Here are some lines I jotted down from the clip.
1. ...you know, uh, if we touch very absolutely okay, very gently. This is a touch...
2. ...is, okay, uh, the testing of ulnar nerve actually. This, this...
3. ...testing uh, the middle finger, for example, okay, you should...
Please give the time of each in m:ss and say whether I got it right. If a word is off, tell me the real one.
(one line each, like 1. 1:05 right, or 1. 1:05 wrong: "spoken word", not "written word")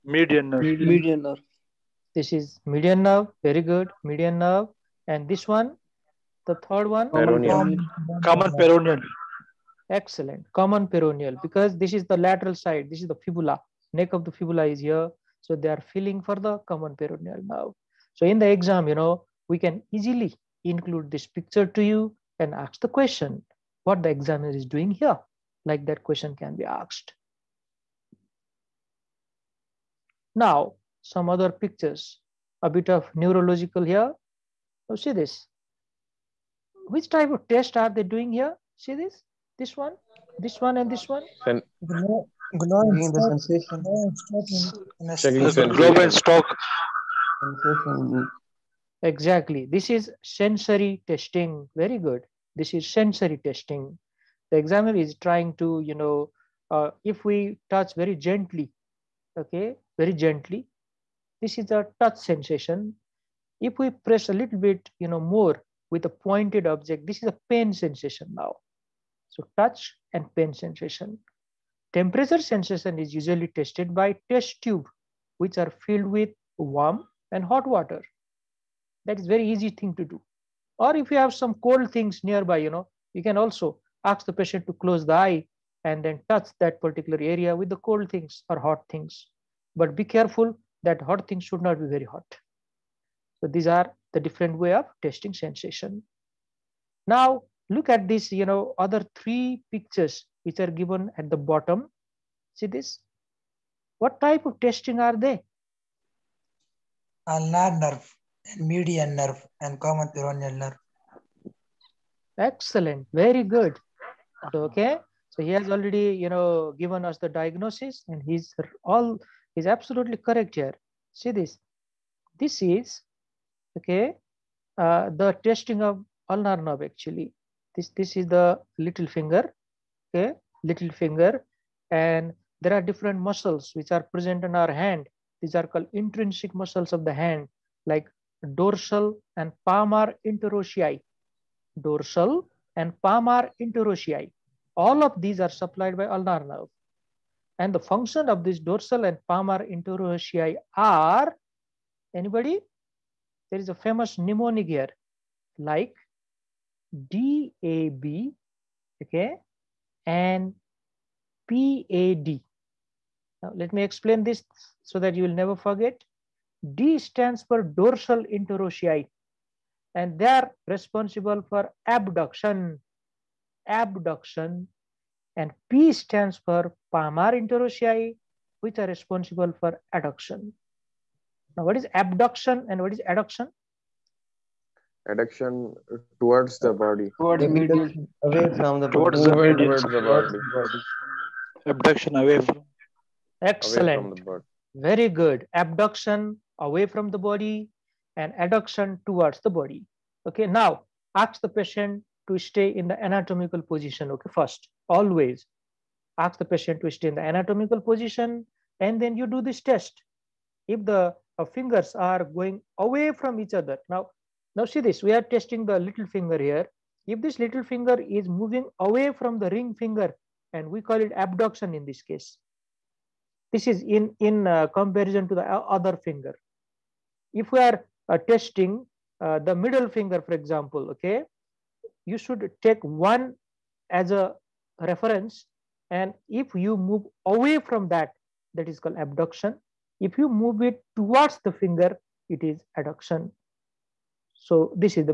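1. 0:55 wrong: "gently", not "absolutely"
2. 2:02 right
3. 3:48 right.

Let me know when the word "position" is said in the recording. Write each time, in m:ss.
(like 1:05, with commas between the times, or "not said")
3:23, 3:27.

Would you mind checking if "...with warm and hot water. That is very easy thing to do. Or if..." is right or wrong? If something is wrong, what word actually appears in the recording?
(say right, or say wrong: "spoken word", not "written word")
right.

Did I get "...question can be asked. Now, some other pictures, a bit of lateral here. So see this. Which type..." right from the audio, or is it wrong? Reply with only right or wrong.
wrong.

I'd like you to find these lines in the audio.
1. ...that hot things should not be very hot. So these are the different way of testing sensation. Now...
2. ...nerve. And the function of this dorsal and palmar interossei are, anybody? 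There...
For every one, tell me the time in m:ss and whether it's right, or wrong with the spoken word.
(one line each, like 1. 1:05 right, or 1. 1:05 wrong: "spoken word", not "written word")
1. 1:30 right
2. 2:26 right.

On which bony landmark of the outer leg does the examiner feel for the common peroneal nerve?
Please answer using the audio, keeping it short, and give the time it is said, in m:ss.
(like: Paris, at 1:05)
Neck of the fibula, at 0:13.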